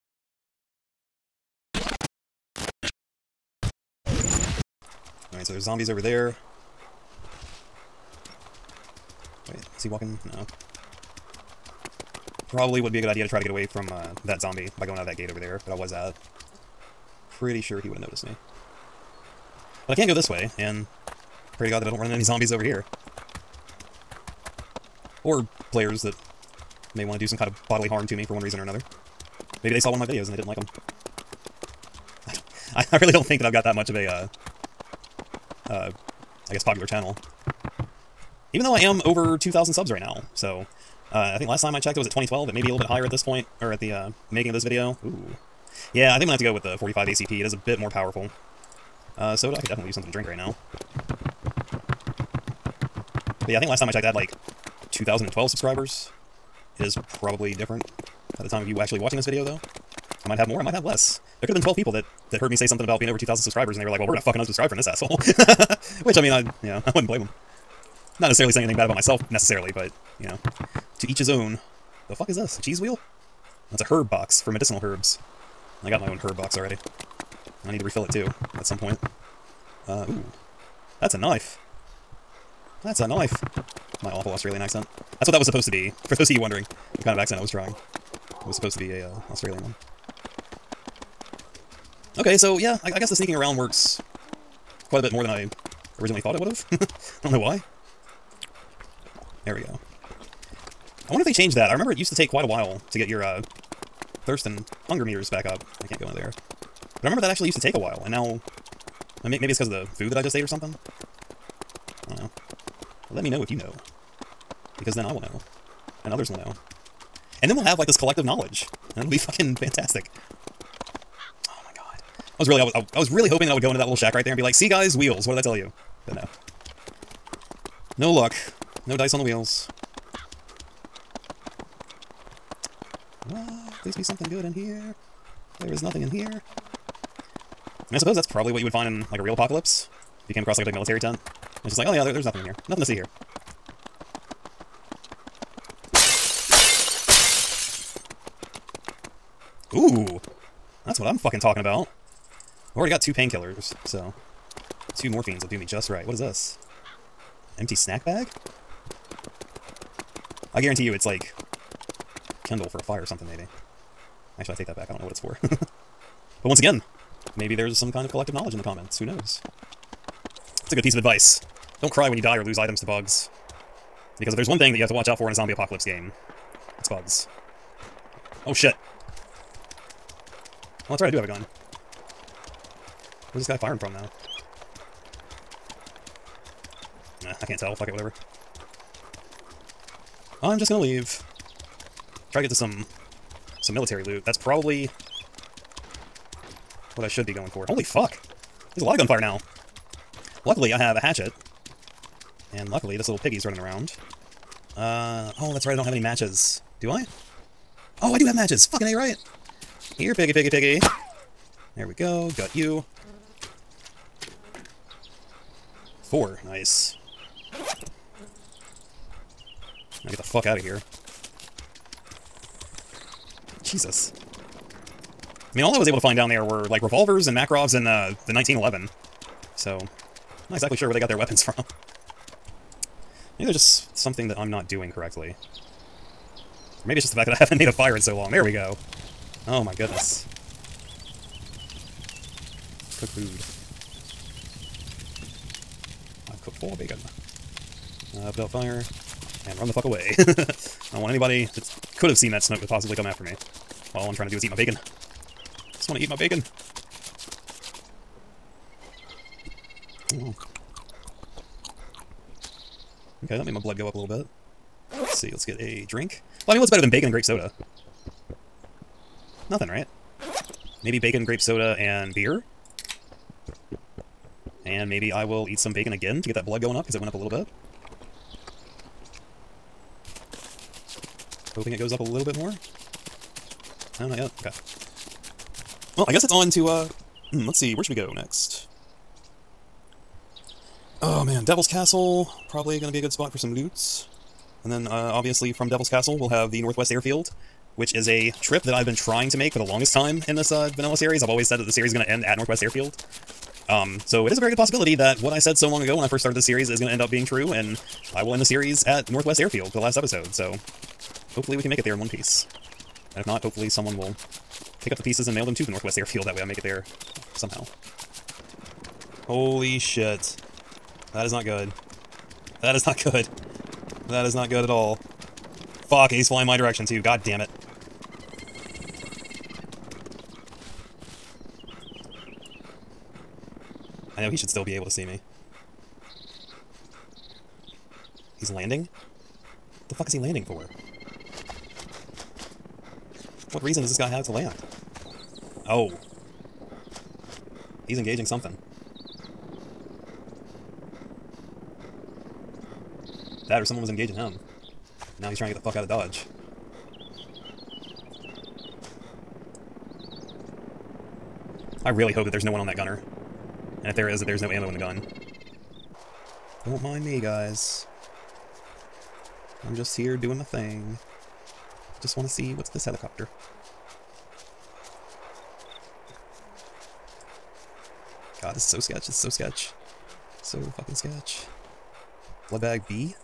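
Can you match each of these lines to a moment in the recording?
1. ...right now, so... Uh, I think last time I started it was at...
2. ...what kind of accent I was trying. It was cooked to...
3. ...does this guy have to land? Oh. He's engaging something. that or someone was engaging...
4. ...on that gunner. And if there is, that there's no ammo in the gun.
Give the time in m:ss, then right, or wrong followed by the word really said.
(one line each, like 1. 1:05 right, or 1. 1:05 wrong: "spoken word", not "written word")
1. 0:39 wrong: "checked", not "started"
2. 1:26 wrong: "supposed", not "cooked"
3. 5:43 right
4. 6:02 right.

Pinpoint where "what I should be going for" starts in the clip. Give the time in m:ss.
3:16.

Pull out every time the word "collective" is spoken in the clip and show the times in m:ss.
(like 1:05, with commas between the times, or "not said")
1:57, 2:48.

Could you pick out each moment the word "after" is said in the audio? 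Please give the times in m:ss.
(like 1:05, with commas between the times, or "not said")
4:13.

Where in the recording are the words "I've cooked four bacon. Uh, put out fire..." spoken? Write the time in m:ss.
4:06.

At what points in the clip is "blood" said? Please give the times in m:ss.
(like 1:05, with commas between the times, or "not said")
4:23, 4:36, 6:22.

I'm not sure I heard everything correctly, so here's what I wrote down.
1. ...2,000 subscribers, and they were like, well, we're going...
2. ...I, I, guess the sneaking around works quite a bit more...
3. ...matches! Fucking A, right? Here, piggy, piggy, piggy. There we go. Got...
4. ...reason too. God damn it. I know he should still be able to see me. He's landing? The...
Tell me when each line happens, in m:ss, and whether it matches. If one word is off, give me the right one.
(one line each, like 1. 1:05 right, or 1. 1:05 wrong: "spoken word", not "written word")
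1. 1:03 right
2. 1:32 right
3. 3:28 right
4. 5:26 wrong: "direction", not "reason".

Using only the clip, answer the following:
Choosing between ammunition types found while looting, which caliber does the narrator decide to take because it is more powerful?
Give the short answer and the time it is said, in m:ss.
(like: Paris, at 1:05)
45 ACP, at 0:46.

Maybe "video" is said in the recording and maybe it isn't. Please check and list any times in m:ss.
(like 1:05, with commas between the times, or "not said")
0:30, 0:44, 0:59.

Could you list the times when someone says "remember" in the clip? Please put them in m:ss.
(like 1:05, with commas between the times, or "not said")
1:41, 1:47.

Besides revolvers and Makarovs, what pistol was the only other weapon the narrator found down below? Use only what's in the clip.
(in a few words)
the 1911.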